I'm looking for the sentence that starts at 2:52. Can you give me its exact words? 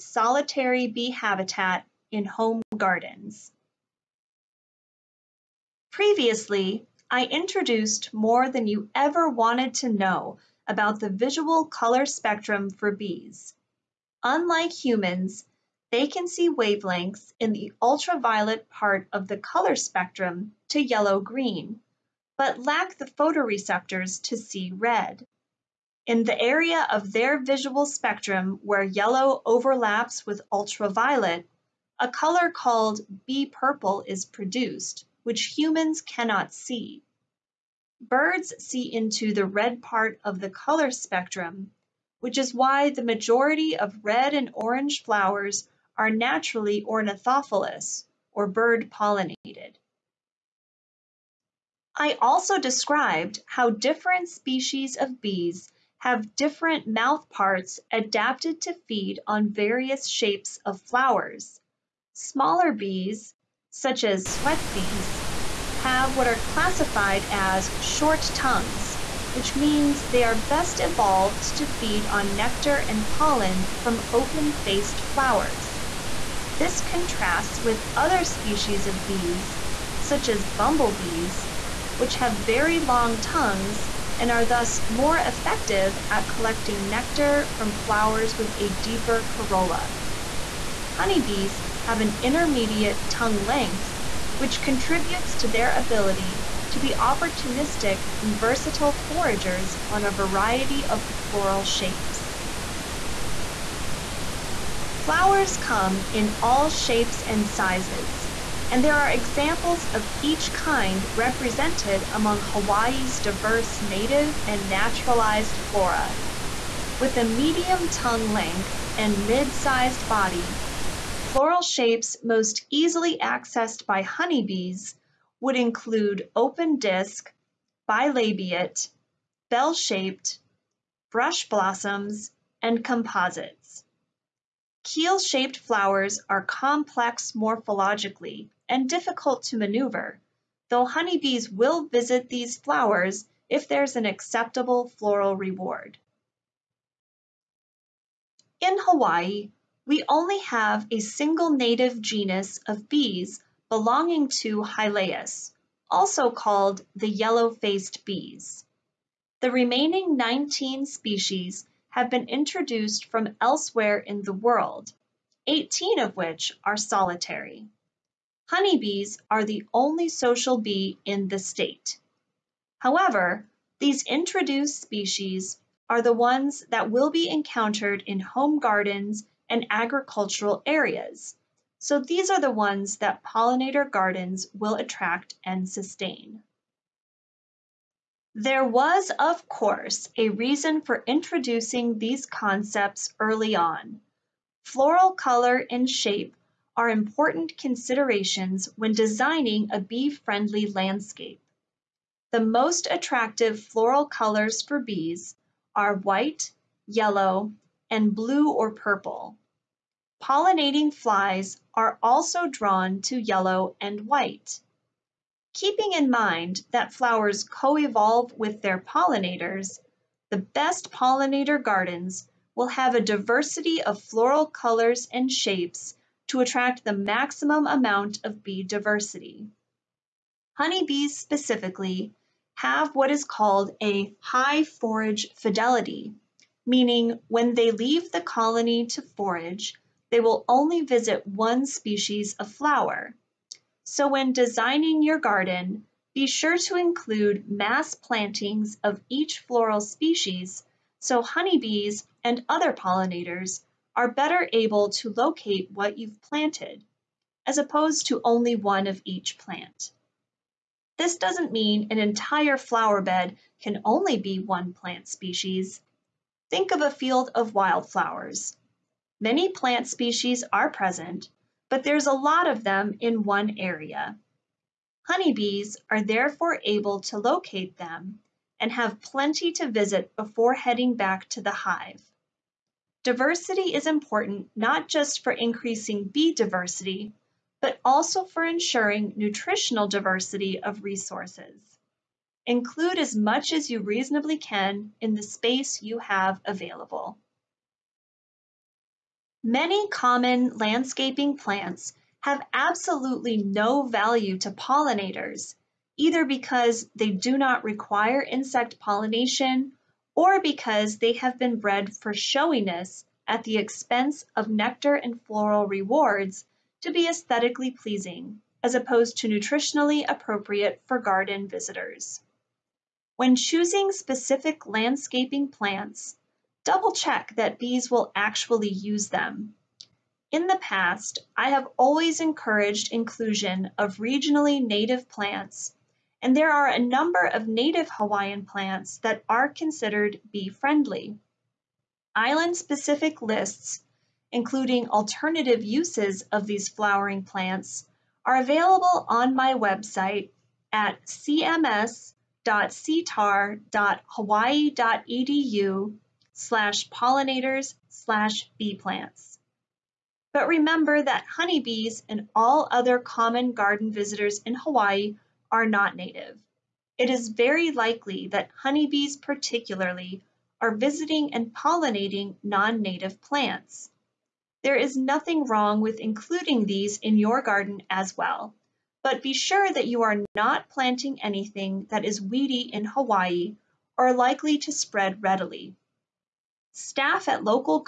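However, these introduced species are the ones that will be encountered in home gardens and agricultural areas.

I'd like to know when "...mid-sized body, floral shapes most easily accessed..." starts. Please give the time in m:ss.
1:59.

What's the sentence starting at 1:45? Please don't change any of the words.
Flowers come in all shapes and sizes, and there are examples of each kind represented among Hawaii's diverse native and naturalized flora.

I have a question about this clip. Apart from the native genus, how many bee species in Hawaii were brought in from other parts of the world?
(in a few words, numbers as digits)
19.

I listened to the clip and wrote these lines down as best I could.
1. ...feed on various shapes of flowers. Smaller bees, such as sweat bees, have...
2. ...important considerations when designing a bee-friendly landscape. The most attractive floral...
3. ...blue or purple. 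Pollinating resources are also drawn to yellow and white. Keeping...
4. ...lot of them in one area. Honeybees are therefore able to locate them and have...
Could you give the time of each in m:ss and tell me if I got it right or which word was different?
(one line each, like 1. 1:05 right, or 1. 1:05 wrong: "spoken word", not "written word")
1. 0:58 right
2. 3:16 right
3. 3:28 wrong: "flies", not "resources"
4. 4:32 right.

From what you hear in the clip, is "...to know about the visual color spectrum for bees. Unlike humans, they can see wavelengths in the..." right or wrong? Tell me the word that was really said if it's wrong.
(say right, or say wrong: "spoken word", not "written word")
right.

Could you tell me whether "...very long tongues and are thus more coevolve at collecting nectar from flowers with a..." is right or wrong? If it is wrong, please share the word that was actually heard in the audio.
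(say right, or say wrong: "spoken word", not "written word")
wrong: "effective", not "coevolve".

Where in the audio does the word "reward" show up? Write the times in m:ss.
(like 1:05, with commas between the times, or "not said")
2:25, 5:15.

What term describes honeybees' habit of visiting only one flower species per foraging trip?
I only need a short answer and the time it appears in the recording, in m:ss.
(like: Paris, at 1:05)
high forage fidelity, at 3:54.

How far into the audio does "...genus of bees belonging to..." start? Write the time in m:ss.
2:31.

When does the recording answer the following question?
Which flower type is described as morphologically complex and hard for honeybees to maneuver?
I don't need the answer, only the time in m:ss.
2:14.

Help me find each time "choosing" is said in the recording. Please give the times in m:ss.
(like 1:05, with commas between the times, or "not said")
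5:23.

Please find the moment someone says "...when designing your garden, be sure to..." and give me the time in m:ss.
4:04.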